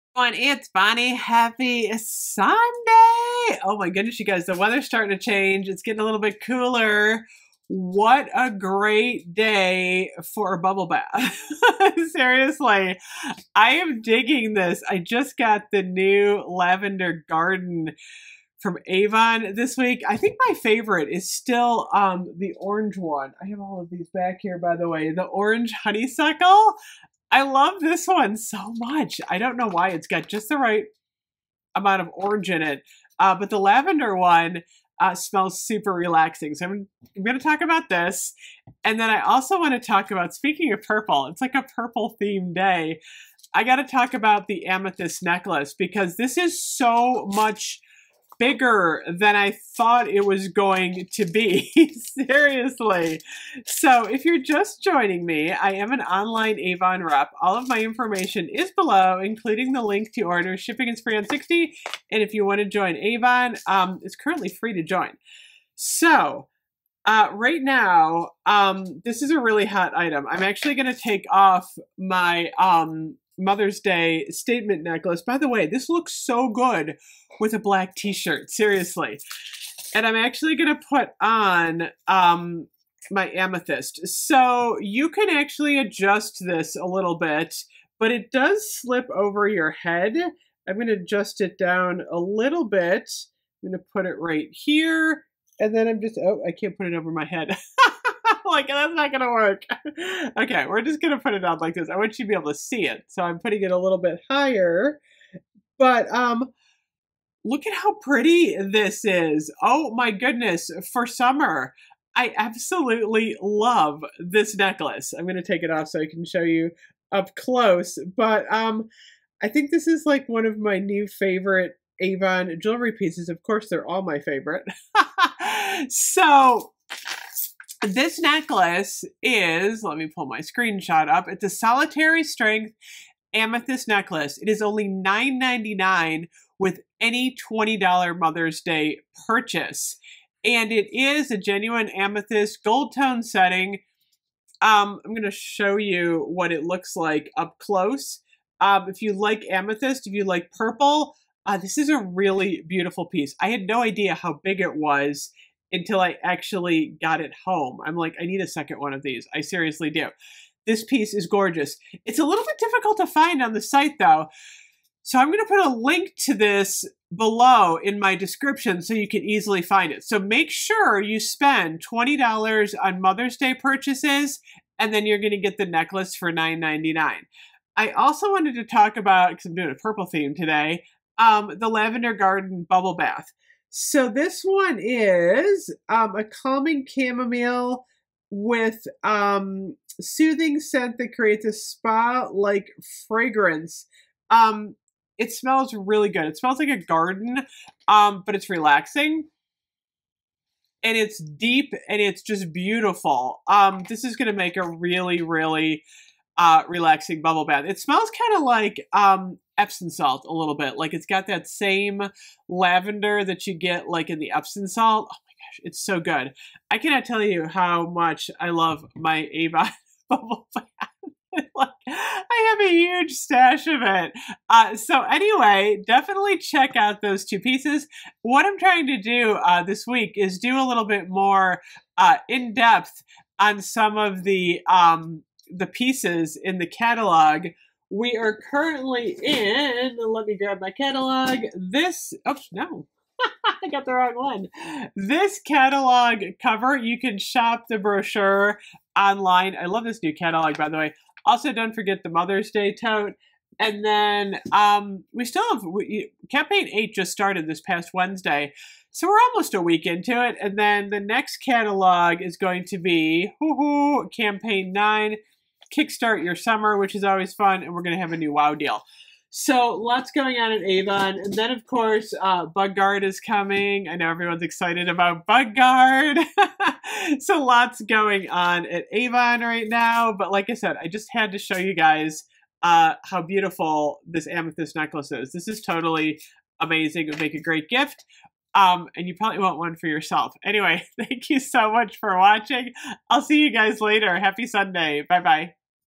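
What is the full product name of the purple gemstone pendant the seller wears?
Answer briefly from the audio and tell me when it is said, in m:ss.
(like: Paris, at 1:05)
Solitaire Strength amethyst necklace, at 2:11.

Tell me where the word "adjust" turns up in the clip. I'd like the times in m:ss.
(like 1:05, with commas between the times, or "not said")
1:25, 1:30.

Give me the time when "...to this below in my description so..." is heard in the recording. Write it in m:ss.
2:46.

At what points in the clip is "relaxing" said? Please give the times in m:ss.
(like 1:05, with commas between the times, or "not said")
0:35, 3:18, 3:26.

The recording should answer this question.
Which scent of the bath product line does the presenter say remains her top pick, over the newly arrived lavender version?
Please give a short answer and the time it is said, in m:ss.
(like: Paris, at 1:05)
Orange honeysuckle, at 0:25.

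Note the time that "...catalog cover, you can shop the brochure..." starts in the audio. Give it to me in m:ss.
4:05.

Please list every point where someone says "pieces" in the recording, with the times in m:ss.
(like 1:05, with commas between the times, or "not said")
2:02, 2:33, 2:40, 3:47, 3:55.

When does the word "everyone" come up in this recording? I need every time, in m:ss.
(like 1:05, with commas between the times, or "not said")
0:00, 4:34.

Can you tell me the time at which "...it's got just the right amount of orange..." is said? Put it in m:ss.
0:29.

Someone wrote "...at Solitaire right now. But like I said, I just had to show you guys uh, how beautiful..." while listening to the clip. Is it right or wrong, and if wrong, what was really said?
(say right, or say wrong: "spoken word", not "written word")
wrong: "Avon", not "Solitaire".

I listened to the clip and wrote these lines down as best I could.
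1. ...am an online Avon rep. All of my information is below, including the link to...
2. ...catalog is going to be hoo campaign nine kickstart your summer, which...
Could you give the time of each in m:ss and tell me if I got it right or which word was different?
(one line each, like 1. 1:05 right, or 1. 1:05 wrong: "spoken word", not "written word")
1. 0:55 right
2. 4:21 right.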